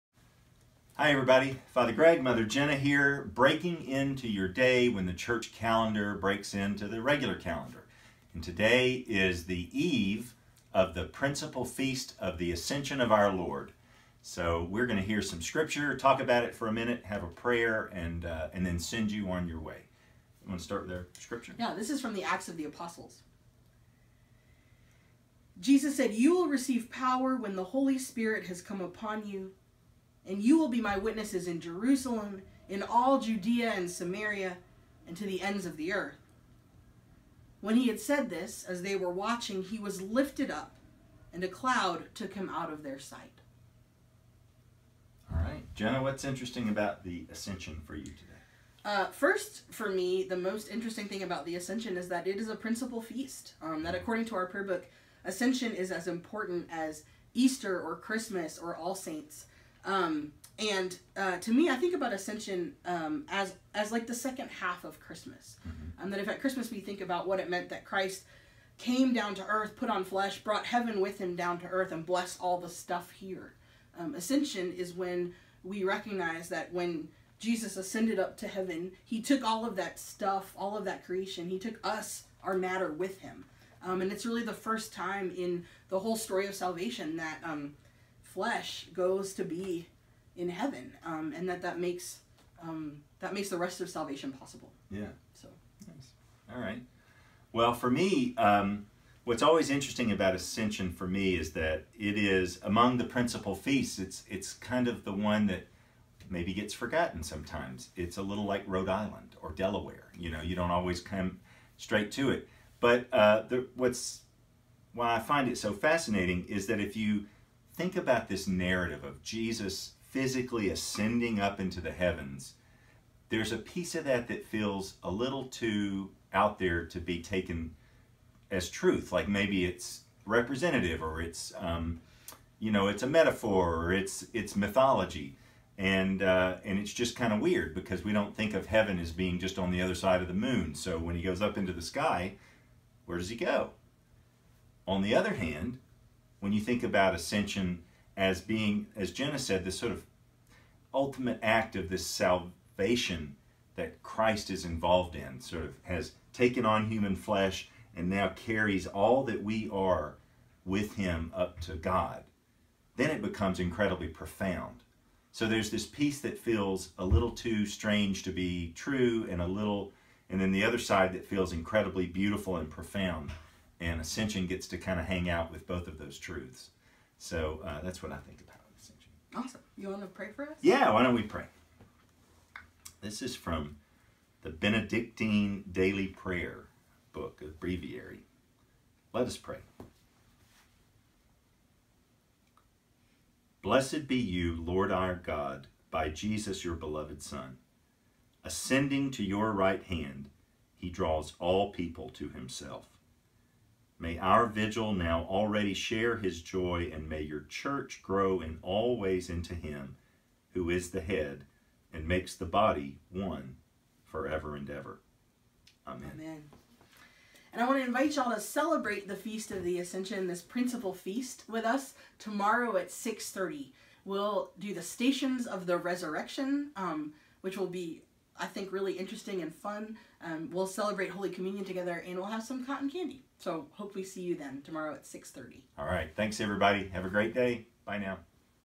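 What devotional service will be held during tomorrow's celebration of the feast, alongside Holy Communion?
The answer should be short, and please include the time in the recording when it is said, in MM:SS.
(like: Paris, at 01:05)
Stations of the Resurrection, at 03:44.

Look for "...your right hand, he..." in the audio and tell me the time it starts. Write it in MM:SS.
03:19.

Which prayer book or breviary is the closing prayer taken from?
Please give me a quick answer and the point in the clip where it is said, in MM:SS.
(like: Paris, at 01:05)
Benedictine Daily Prayer, at 03:04.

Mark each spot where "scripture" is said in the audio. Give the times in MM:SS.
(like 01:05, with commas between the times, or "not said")
00:15, 00:21.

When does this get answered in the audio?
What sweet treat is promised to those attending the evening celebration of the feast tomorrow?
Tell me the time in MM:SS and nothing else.
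03:52.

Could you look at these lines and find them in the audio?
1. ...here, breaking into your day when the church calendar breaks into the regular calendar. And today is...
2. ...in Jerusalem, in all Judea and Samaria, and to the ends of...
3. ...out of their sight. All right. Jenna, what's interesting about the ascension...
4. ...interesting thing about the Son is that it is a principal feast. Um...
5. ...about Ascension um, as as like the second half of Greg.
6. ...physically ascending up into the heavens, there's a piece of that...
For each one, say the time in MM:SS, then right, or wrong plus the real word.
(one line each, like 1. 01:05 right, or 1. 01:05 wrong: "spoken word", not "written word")
1. 00:02 right
2. 00:31 right
3. 00:42 right
4. 00:50 wrong: "Ascension", not "Son"
5. 01:01 wrong: "Christmas", not "Greg"
6. 02:00 right.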